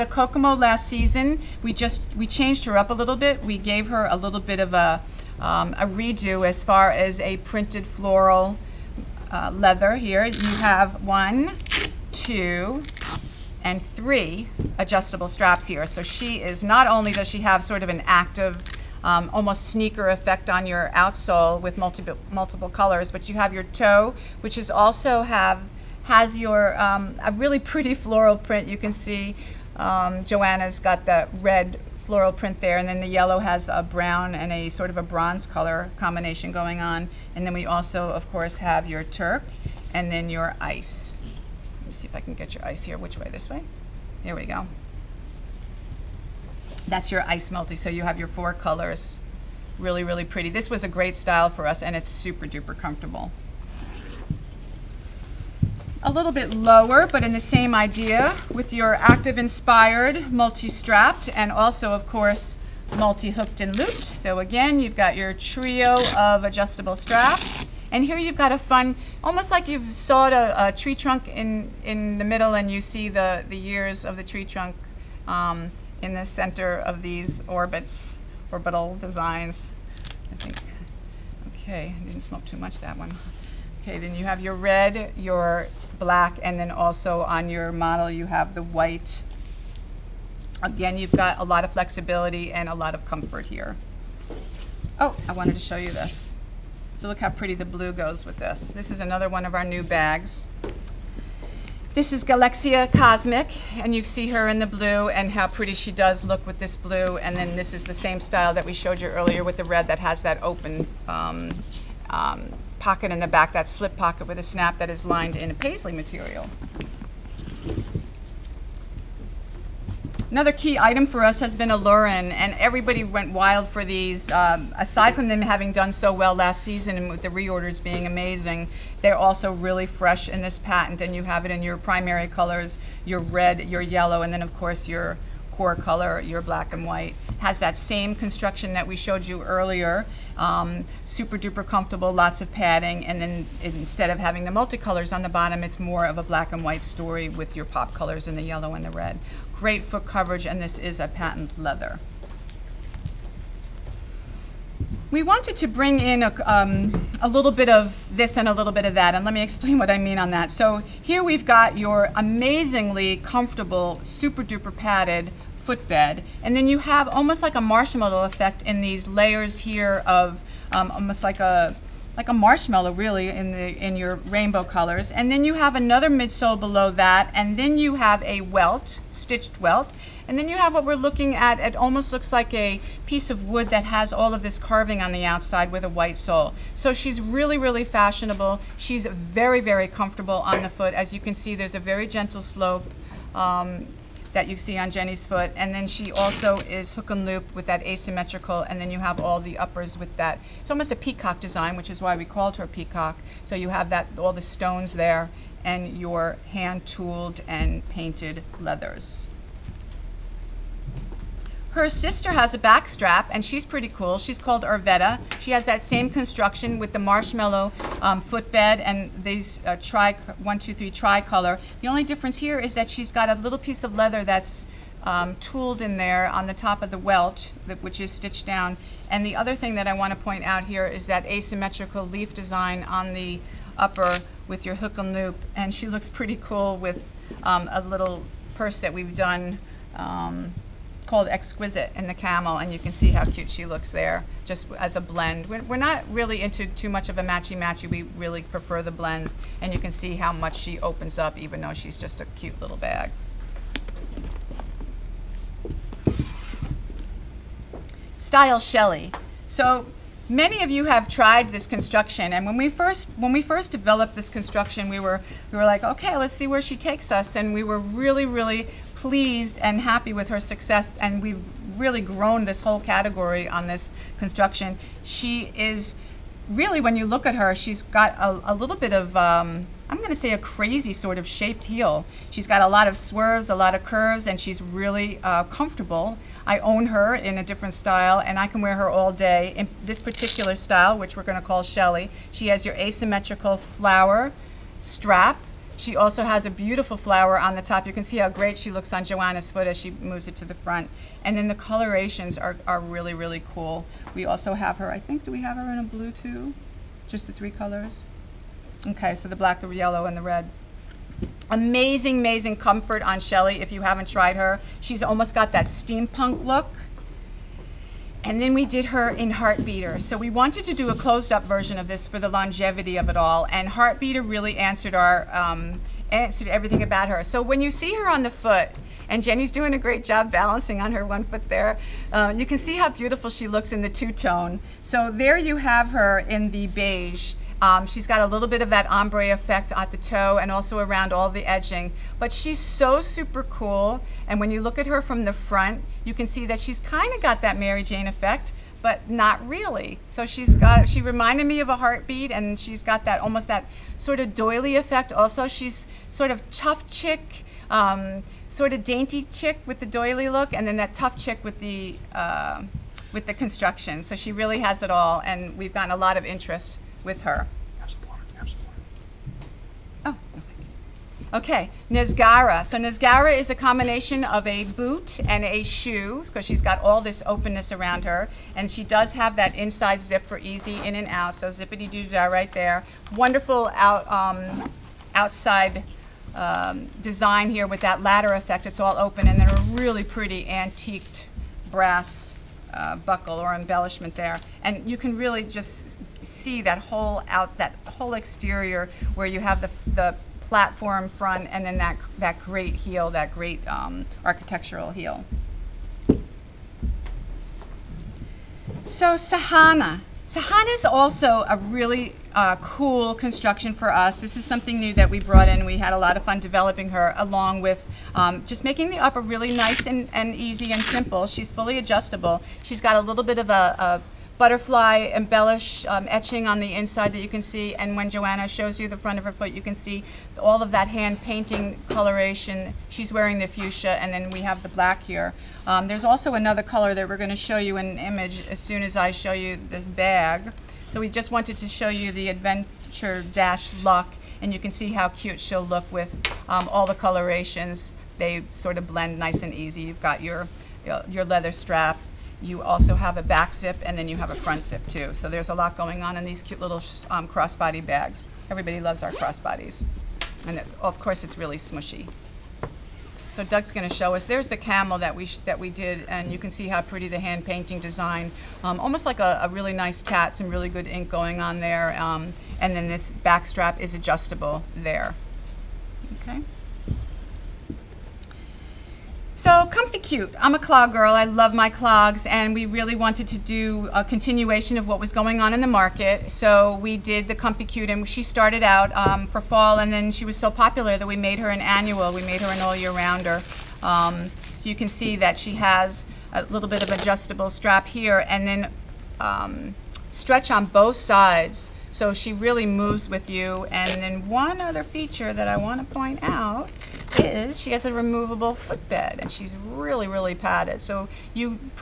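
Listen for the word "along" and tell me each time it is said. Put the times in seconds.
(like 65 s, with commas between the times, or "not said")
417 s.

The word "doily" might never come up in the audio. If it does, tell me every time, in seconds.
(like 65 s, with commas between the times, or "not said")
354 s, 359 s.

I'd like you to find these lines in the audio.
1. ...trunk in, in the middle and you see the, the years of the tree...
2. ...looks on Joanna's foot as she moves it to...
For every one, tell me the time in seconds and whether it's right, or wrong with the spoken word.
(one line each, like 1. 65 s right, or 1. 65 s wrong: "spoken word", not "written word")
1. 70 s right
2. 298 s right.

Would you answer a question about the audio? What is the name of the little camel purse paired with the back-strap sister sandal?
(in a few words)
Exquisite.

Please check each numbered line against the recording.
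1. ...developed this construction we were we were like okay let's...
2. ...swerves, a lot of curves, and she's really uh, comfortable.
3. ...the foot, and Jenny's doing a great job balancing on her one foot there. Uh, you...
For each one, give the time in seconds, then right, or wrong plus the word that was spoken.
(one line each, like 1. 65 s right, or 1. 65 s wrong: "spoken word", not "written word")
1. 263 s right
2. 282 s right
3. 328 s right.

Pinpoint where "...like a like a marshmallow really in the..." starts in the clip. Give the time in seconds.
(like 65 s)
171 s.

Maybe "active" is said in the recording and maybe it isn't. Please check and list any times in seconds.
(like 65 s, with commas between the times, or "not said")
18 s, 58 s.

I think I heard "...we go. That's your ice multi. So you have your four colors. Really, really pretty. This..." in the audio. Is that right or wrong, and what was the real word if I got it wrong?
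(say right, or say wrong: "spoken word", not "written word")
right.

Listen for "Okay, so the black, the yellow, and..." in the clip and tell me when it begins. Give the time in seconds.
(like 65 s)
308 s.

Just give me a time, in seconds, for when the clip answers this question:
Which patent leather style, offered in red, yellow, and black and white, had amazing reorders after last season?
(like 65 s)
121 s.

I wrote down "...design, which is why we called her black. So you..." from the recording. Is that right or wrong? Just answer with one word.
wrong.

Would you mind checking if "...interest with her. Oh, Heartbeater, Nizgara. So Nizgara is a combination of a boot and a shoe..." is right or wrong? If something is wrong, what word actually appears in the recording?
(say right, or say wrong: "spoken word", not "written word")
wrong: "Okay", not "Heartbeater".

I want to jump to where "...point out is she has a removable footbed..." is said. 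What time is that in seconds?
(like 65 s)
505 s.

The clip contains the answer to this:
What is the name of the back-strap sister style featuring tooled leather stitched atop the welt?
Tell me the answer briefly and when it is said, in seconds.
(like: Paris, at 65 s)
Arvetta, at 214 s.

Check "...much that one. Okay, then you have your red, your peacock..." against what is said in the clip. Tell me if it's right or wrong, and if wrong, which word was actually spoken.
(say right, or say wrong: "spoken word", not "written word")
wrong: "black", not "peacock".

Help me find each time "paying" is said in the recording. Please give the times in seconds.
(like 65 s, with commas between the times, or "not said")
not said.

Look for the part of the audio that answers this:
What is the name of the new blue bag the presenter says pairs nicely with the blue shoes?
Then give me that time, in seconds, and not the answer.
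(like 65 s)
102 s.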